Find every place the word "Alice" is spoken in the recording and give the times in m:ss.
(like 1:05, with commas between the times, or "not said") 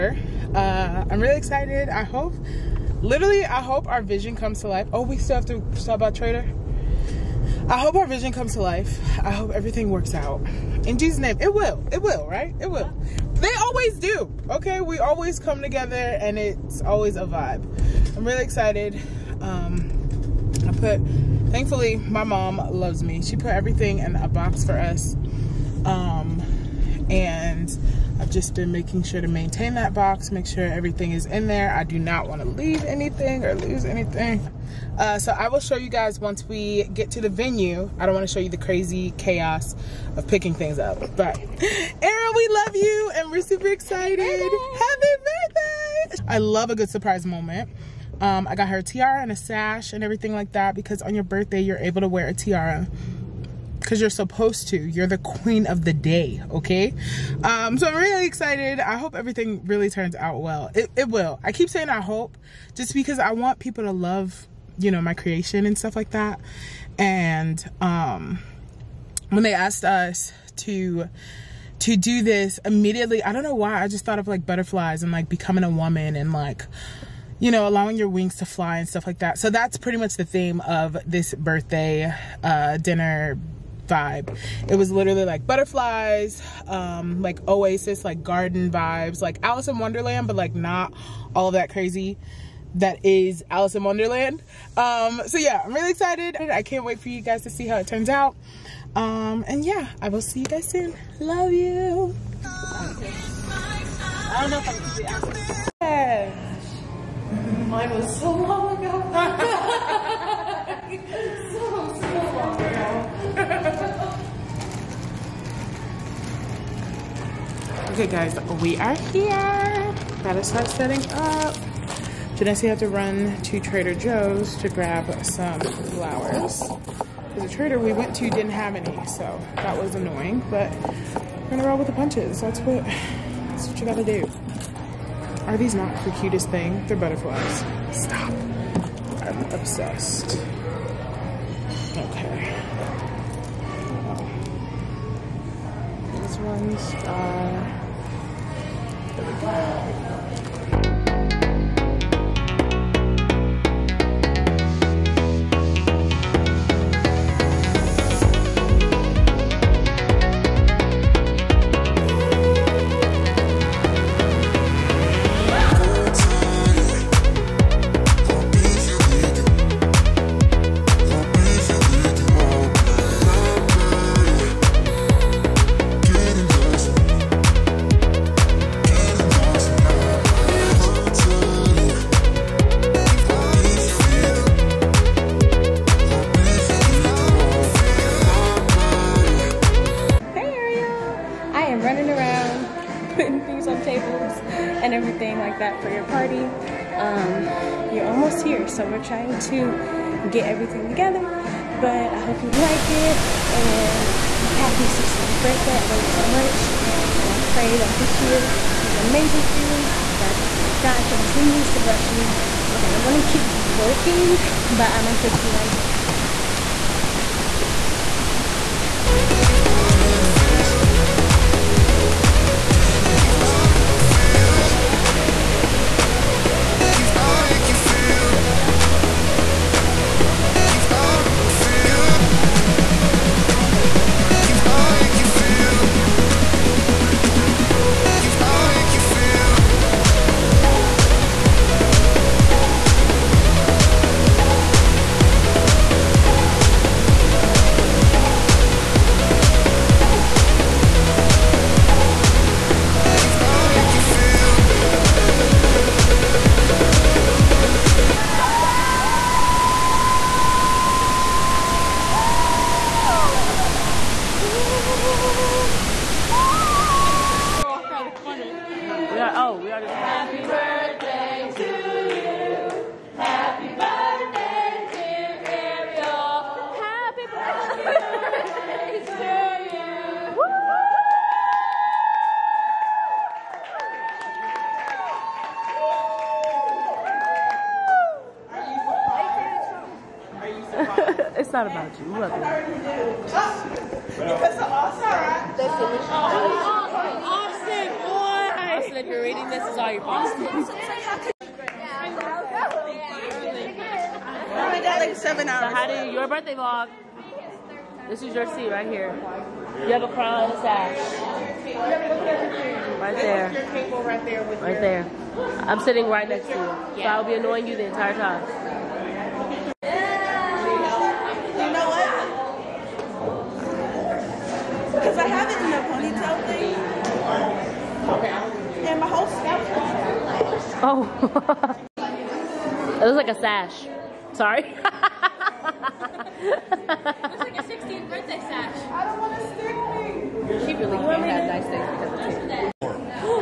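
1:29, 1:33.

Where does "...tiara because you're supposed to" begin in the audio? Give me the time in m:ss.
0:52.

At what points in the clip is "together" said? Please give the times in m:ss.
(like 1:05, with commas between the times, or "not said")
0:15, 3:20.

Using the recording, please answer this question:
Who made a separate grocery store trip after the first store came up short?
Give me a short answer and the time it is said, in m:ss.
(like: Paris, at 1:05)
Janessa, at 2:02.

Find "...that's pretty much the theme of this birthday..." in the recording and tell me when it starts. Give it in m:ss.
1:19.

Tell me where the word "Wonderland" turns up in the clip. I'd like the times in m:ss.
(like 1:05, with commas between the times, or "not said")
1:29, 1:33.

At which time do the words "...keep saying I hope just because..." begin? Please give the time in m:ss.
1:01.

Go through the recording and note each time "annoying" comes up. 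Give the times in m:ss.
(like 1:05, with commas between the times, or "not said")
2:09, 5:17.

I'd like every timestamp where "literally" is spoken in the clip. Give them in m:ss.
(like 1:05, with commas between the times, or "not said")
0:03, 1:24.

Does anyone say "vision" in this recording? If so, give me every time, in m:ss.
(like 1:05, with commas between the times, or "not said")
0:04, 0:08.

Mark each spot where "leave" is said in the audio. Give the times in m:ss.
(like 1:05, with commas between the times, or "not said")
0:32.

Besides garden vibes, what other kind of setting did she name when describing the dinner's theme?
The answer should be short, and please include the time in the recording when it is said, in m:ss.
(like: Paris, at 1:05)
Oasis, at 1:27.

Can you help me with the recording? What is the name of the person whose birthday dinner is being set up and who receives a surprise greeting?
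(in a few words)
Erin.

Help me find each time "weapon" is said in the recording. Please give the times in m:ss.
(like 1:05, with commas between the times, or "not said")
not said.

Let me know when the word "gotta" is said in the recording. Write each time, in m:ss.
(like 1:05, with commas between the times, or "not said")
2:00, 2:13.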